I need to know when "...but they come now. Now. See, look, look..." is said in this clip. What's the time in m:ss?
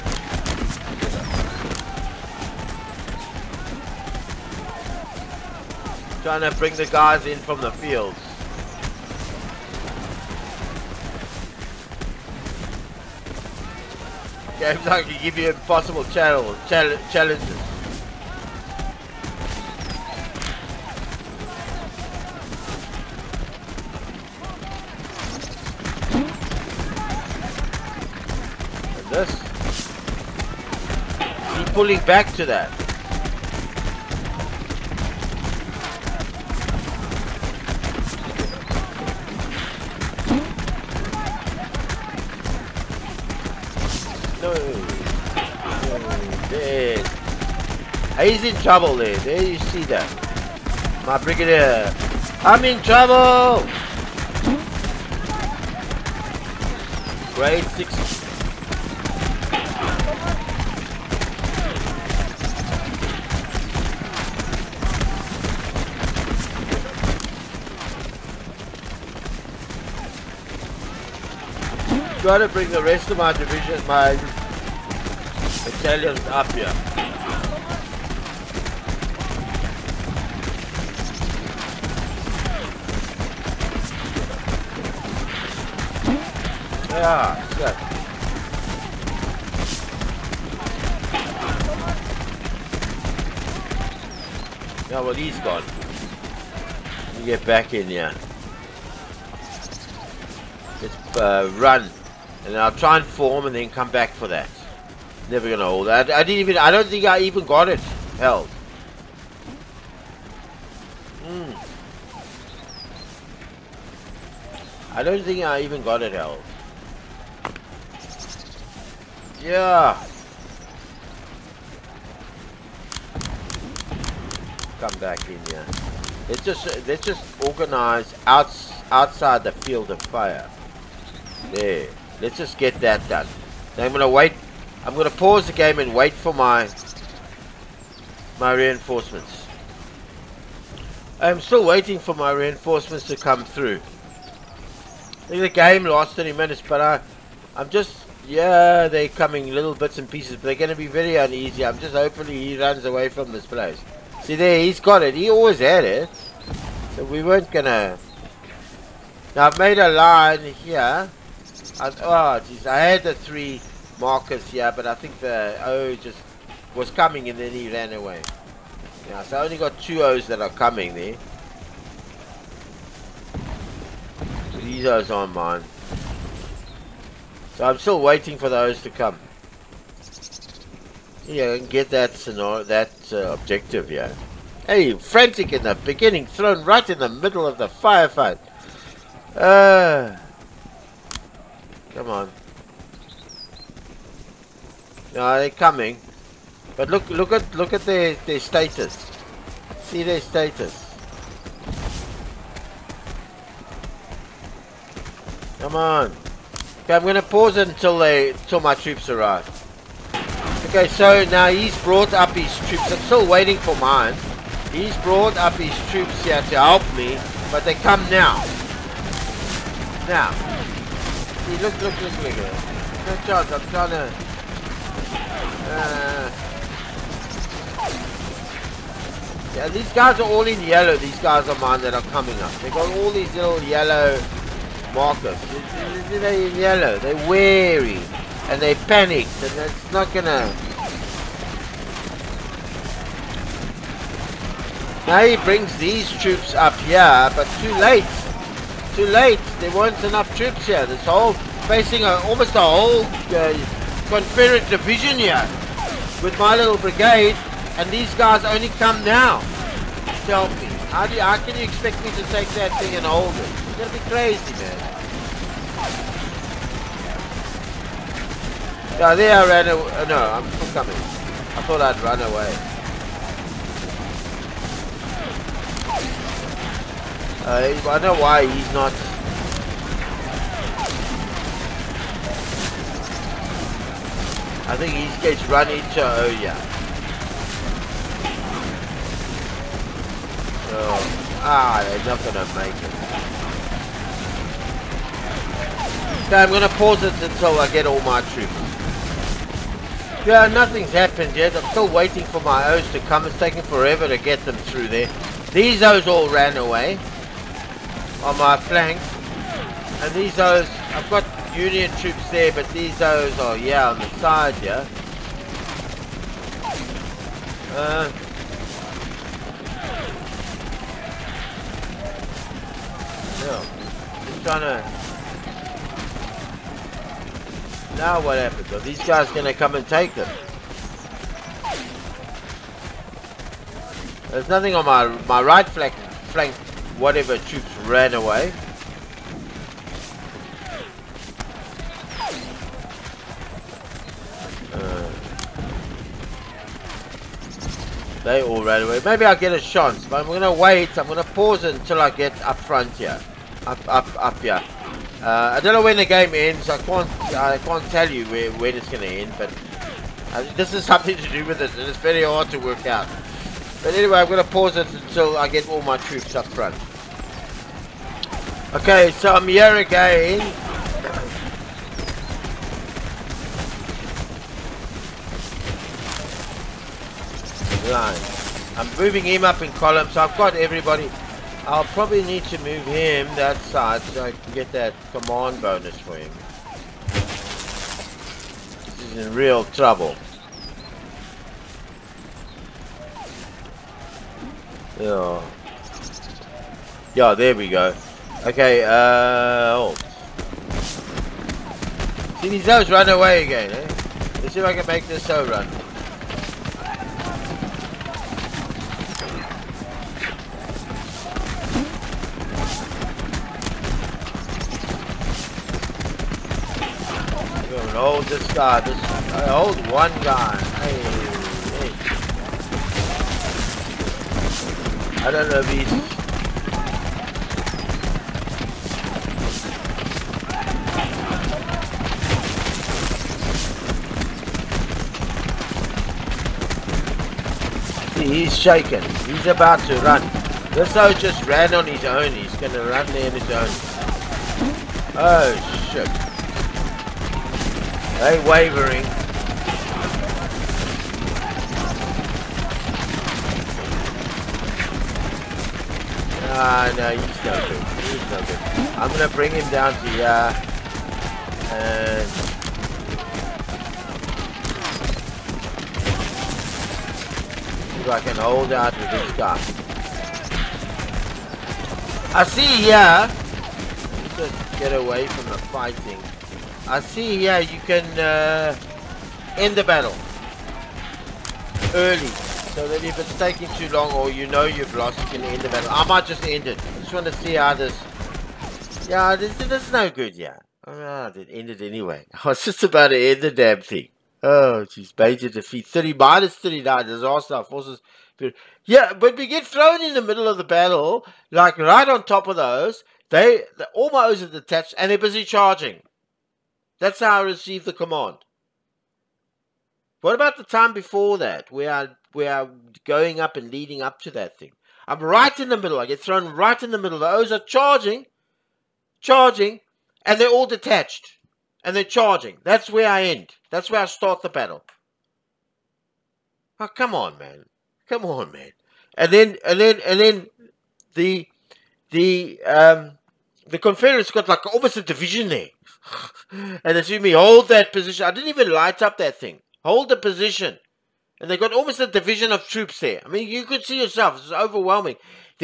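3:37.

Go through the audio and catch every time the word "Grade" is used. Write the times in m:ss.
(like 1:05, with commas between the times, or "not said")
0:57.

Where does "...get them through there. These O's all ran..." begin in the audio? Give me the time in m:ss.
5:04.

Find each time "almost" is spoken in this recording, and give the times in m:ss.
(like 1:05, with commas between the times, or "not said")
4:12, 8:54, 9:01.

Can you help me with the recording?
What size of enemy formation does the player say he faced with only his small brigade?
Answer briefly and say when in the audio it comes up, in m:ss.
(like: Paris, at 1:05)
Confederate division, at 4:14.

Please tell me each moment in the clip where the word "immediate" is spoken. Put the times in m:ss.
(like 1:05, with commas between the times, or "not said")
not said.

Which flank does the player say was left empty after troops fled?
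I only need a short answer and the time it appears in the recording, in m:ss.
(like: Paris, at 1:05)
Right flank, at 5:35.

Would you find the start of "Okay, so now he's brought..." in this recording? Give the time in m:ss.
3:30.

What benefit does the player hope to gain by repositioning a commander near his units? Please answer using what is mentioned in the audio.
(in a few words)
Command bonus.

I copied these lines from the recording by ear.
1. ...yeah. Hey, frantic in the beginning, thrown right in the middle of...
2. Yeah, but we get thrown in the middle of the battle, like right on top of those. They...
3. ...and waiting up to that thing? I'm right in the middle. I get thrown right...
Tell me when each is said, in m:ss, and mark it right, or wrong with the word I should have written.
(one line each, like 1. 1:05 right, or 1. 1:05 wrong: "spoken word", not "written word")
1. 3:03 right
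2. 8:18 right
3. 8:33 wrong: "leading", not "waiting".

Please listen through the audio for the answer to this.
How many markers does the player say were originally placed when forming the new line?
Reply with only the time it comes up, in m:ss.
2:43.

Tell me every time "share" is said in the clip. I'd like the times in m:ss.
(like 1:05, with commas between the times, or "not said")
not said.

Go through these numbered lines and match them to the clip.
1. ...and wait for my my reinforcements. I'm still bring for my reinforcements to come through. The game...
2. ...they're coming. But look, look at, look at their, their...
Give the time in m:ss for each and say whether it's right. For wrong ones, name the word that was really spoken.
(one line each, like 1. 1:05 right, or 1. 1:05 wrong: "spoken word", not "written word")
1. 2:15 wrong: "waiting", not "bring"
2. 3:15 right.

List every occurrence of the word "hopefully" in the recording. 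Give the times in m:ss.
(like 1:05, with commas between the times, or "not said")
2:31.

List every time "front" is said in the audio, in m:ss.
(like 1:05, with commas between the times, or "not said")
5:52, 6:06.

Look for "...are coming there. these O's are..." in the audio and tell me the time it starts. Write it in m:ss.
2:50.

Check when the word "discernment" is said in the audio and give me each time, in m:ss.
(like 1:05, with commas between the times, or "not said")
not said.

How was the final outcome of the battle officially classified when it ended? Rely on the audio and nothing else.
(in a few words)
Major defeat.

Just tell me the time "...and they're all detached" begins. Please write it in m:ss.
8:40.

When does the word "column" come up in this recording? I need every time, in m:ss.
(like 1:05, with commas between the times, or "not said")
6:19.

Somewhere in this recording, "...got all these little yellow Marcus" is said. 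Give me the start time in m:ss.
3:52.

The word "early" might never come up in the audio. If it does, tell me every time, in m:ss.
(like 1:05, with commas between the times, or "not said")
8:01.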